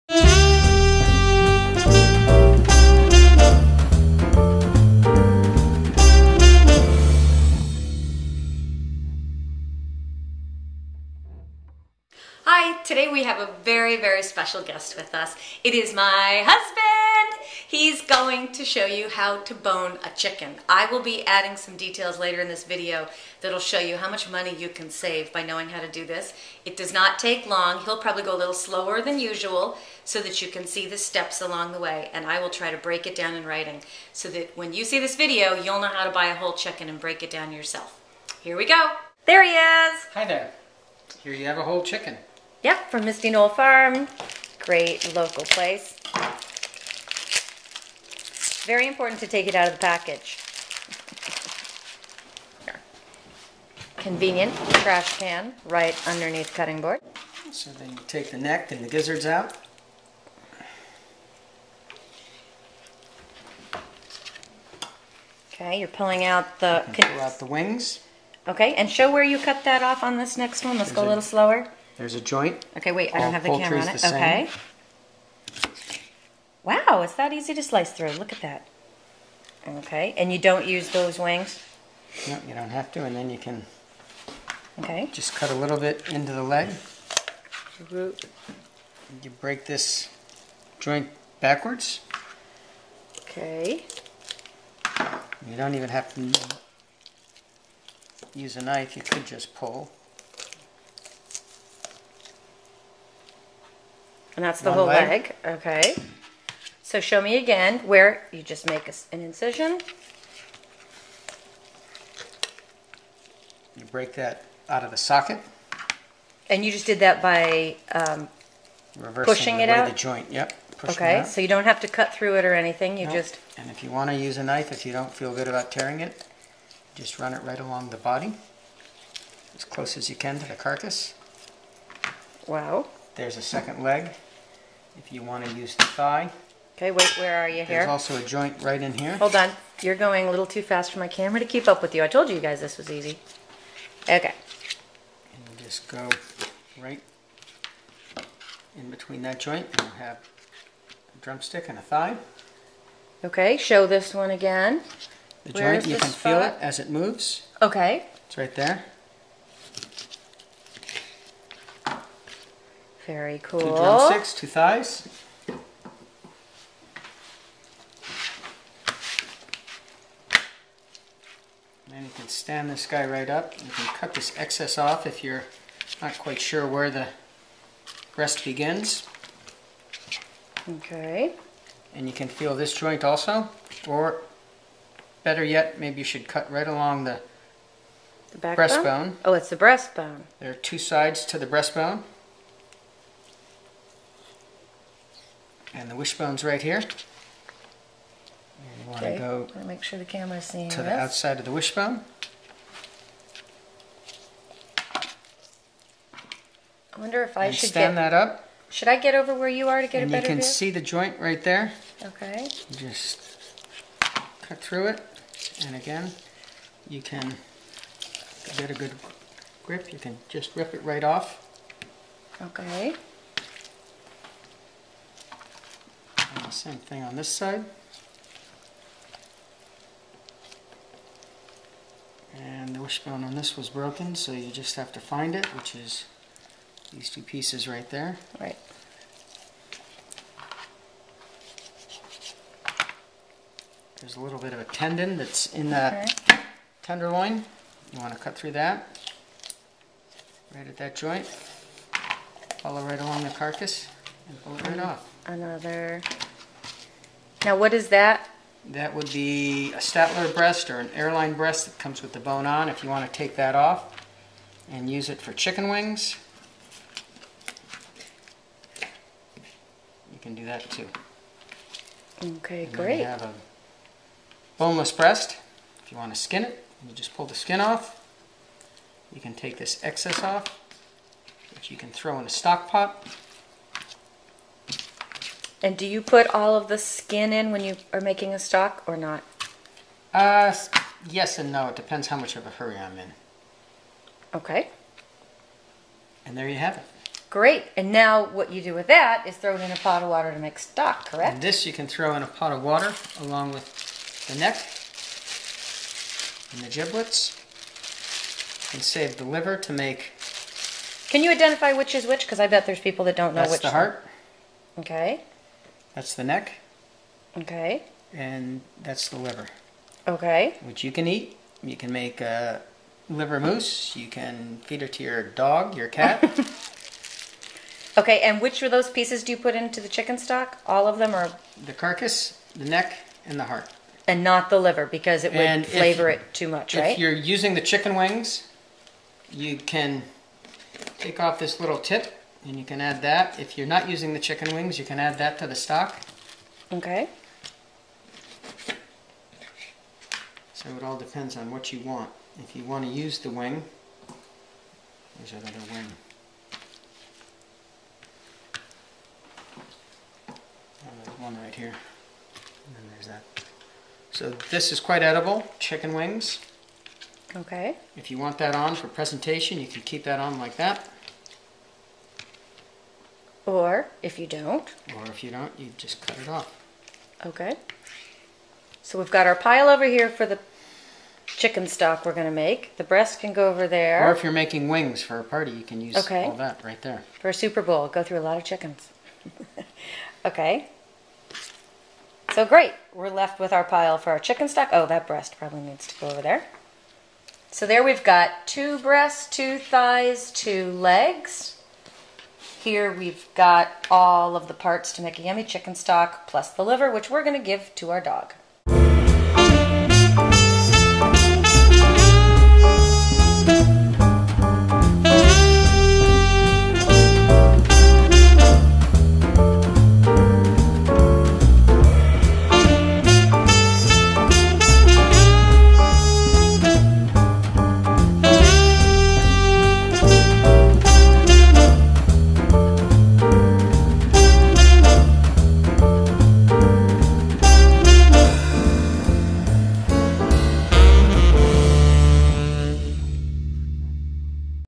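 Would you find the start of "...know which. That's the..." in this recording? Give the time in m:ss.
5:13.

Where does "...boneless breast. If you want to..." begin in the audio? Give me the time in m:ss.
4:34.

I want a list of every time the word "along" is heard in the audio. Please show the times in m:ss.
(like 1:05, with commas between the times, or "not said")
0:31, 2:07, 3:06, 4:12, 5:03.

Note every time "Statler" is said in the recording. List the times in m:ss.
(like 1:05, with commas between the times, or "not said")
4:19.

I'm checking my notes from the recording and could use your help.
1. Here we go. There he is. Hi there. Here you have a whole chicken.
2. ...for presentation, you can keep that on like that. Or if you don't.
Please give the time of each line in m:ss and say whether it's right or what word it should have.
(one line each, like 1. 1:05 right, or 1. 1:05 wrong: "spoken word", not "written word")
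1. 0:38 right
2. 6:08 right.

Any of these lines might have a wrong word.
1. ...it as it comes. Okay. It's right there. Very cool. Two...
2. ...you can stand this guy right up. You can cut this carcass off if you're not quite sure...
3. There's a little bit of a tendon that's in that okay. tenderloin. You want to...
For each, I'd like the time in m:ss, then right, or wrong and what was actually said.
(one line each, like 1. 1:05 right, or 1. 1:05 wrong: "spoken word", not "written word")
1. 2:36 wrong: "moves", not "comes"
2. 2:52 wrong: "excess", not "carcass"
3. 4:04 right.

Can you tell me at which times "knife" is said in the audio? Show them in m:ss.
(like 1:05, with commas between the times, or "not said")
1:38, 2:04.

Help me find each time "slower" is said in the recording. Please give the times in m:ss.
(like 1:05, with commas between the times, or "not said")
0:28, 1:11.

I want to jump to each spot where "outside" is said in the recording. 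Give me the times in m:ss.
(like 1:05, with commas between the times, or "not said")
3:20.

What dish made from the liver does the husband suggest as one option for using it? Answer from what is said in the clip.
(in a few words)
liver mousse.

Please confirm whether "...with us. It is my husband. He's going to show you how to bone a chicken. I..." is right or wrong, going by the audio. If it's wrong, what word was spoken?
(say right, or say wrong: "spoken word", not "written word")
right.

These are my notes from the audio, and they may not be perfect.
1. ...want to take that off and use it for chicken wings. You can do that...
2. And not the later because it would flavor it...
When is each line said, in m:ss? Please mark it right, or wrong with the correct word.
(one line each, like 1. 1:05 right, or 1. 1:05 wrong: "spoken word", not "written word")
1. 4:22 right
2. 5:34 wrong: "liver", not "later".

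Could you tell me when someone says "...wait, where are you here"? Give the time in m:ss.
2:16.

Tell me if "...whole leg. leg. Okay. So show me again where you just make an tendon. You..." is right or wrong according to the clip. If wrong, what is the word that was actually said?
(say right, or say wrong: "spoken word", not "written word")
wrong: "incision", not "tendon".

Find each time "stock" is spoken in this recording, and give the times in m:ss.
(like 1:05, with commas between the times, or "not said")
4:42, 4:48, 5:00, 5:30, 5:45, 6:21, 6:34, 6:45.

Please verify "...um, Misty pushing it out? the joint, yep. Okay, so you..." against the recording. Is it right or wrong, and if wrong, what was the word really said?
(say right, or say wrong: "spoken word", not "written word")
wrong: "Reversing", not "Misty".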